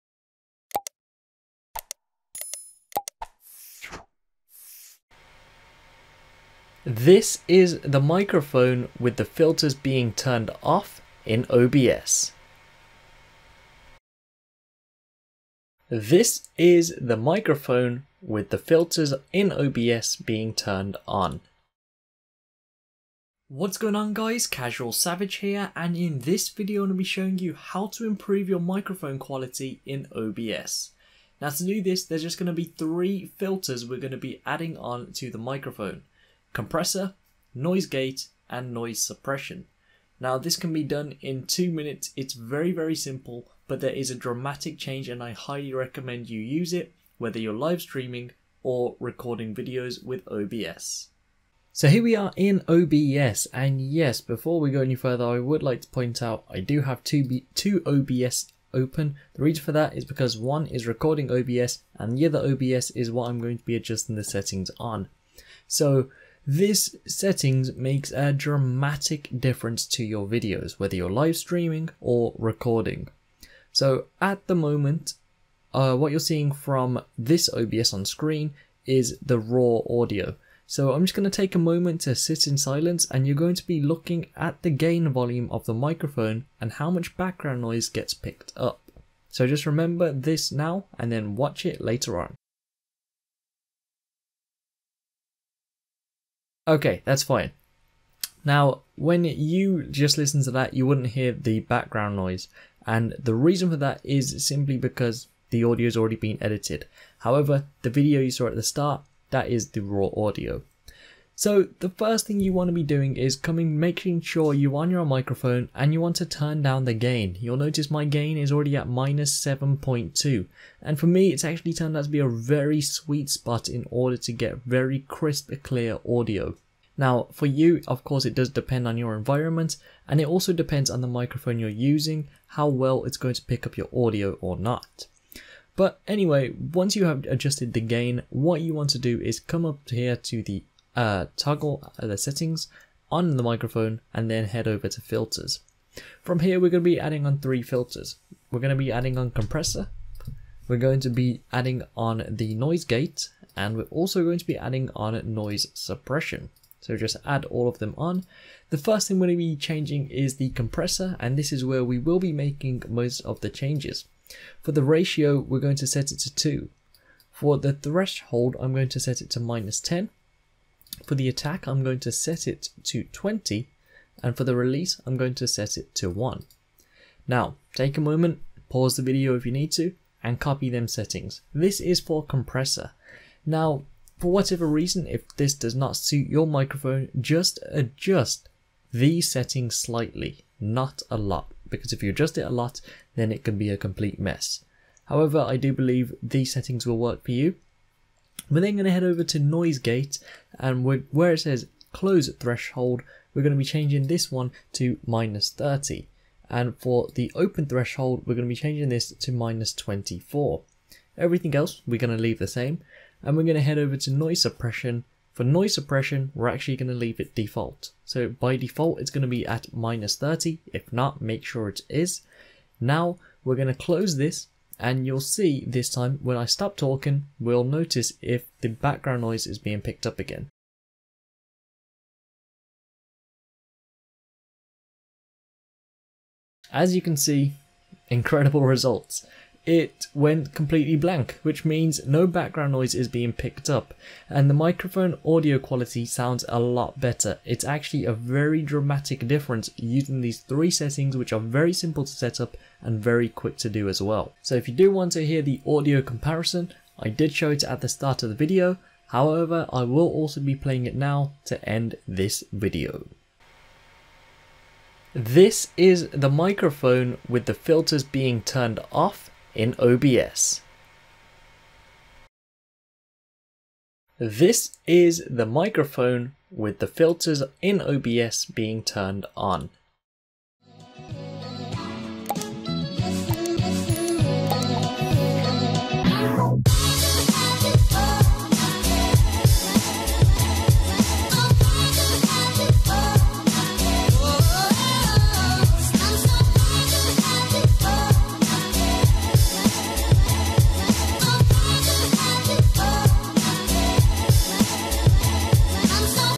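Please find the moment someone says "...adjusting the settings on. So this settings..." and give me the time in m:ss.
1:03.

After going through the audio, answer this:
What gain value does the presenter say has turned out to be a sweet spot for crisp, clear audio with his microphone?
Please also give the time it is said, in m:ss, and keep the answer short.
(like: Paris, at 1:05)
-7.2, at 1:58.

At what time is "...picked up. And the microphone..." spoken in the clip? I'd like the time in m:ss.
4:03.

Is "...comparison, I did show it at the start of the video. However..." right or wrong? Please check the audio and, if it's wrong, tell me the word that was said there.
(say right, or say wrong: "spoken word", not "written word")
right.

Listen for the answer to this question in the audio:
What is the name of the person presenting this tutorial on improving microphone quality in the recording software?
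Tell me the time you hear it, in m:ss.
0:24.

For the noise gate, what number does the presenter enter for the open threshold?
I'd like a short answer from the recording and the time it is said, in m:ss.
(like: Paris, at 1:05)
-24, at 3:29.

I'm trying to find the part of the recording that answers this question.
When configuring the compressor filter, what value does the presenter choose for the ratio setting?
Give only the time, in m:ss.
2:46.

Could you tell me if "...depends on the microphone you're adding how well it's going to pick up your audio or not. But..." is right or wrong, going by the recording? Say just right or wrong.
wrong.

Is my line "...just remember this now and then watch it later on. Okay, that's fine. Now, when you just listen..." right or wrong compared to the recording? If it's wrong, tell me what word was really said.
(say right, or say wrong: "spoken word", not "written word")
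right.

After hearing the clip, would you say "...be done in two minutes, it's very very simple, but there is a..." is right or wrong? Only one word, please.
right.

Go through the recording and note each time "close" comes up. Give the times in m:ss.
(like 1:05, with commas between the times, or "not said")
3:21, 3:43.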